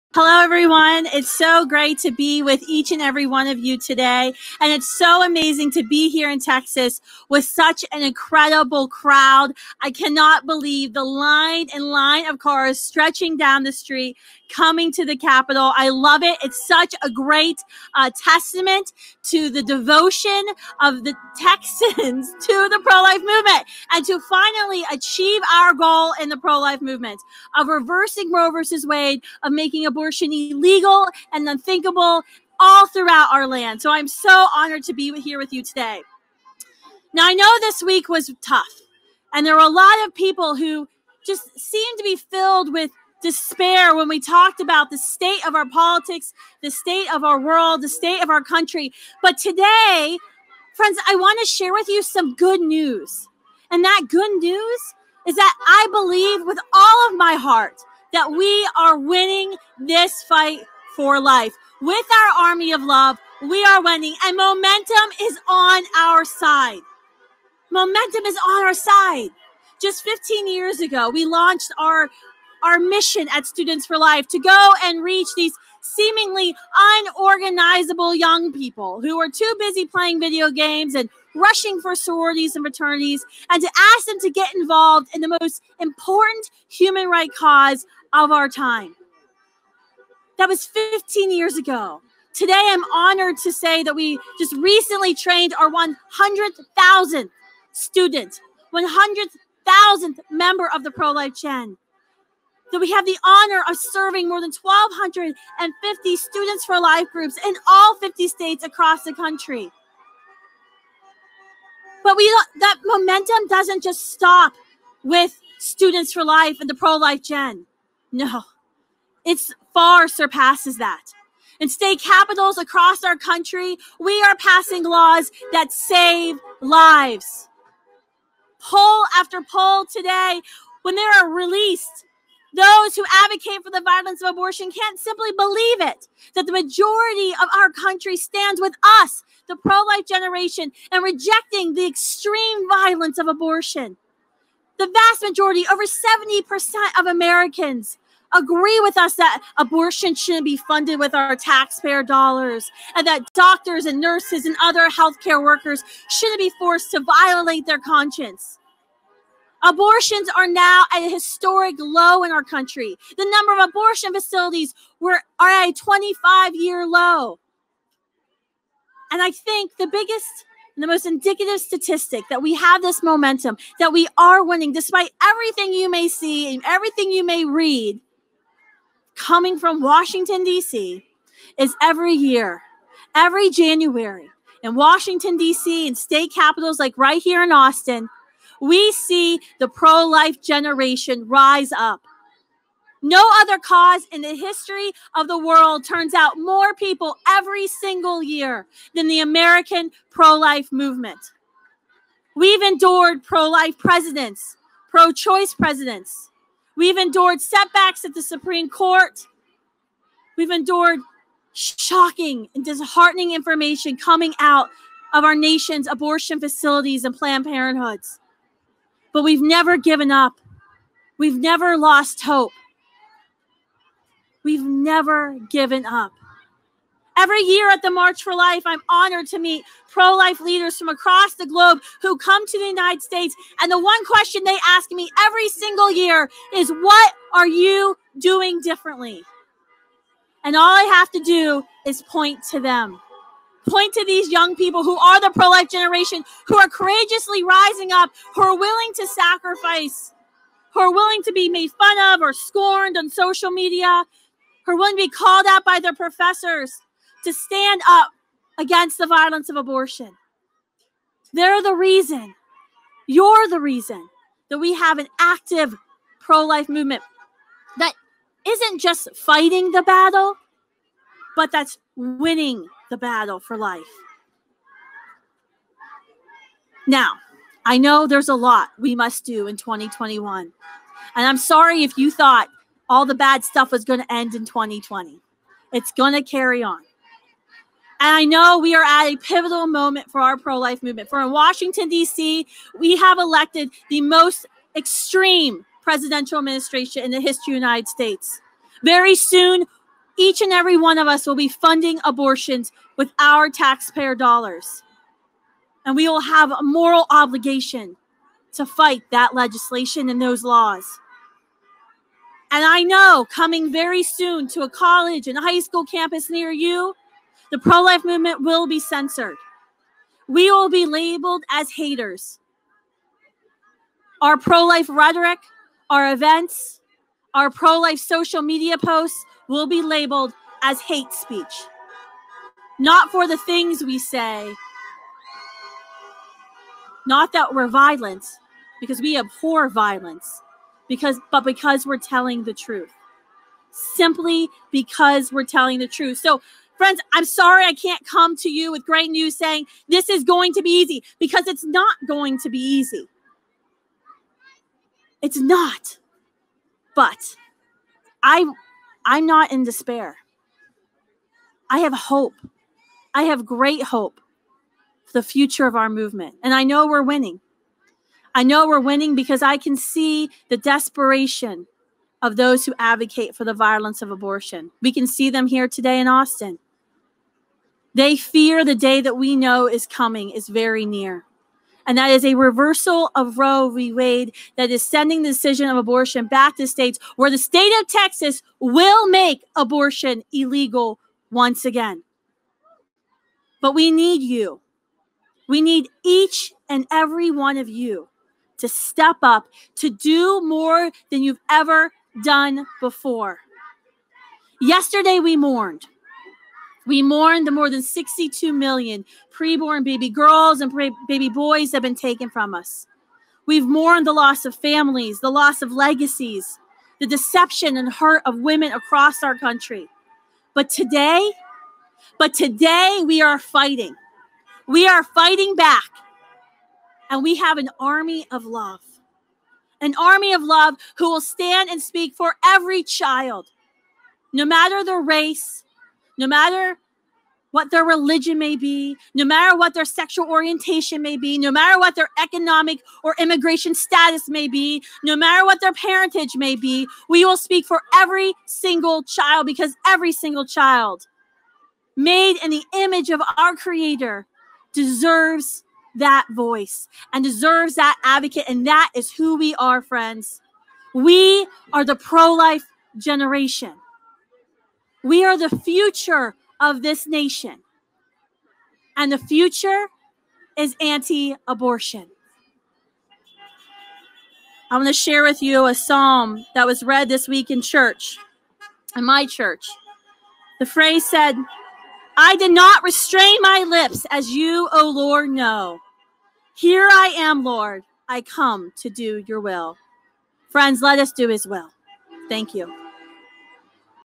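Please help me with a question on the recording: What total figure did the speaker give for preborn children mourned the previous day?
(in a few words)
More than 62 million.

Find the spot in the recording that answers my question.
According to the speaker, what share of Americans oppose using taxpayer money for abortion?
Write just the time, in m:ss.
2:25.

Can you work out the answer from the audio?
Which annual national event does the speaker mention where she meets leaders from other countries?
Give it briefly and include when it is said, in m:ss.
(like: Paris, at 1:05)
March for Life, at 3:47.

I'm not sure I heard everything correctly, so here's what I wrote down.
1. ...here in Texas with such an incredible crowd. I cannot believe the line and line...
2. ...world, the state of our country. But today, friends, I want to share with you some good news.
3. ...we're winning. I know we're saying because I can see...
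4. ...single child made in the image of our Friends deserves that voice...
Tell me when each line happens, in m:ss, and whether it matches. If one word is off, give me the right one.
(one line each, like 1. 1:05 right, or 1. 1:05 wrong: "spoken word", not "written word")
1. 0:06 right
2. 0:47 right
3. 6:06 wrong: "winning", not "saying"
4. 7:30 wrong: "Creator", not "Friends".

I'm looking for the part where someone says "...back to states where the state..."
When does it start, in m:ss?
6:26.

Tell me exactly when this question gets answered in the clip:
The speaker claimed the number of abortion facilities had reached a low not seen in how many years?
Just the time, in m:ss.
2:45.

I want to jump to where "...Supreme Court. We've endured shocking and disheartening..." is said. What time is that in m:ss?
3:28.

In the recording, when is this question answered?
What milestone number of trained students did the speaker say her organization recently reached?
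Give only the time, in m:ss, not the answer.
1:35.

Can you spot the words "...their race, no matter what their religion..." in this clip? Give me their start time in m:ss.
7:14.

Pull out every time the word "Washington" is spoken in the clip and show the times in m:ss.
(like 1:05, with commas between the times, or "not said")
2:59, 3:04, 4:51.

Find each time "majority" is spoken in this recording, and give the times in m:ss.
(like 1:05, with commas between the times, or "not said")
2:16, 2:25.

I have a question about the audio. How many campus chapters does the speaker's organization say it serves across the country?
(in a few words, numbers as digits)
More than 1,250.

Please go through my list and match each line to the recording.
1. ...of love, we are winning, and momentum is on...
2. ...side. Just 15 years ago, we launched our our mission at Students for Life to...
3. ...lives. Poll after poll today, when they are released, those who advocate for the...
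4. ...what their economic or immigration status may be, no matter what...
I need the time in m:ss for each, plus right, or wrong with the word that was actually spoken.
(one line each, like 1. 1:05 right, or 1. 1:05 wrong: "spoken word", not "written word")
1. 1:02 right
2. 1:08 right
3. 2:06 right
4. 7:21 right.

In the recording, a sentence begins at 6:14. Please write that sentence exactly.
We can see them here today in Austin.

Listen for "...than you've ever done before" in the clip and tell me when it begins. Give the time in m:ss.
6:41.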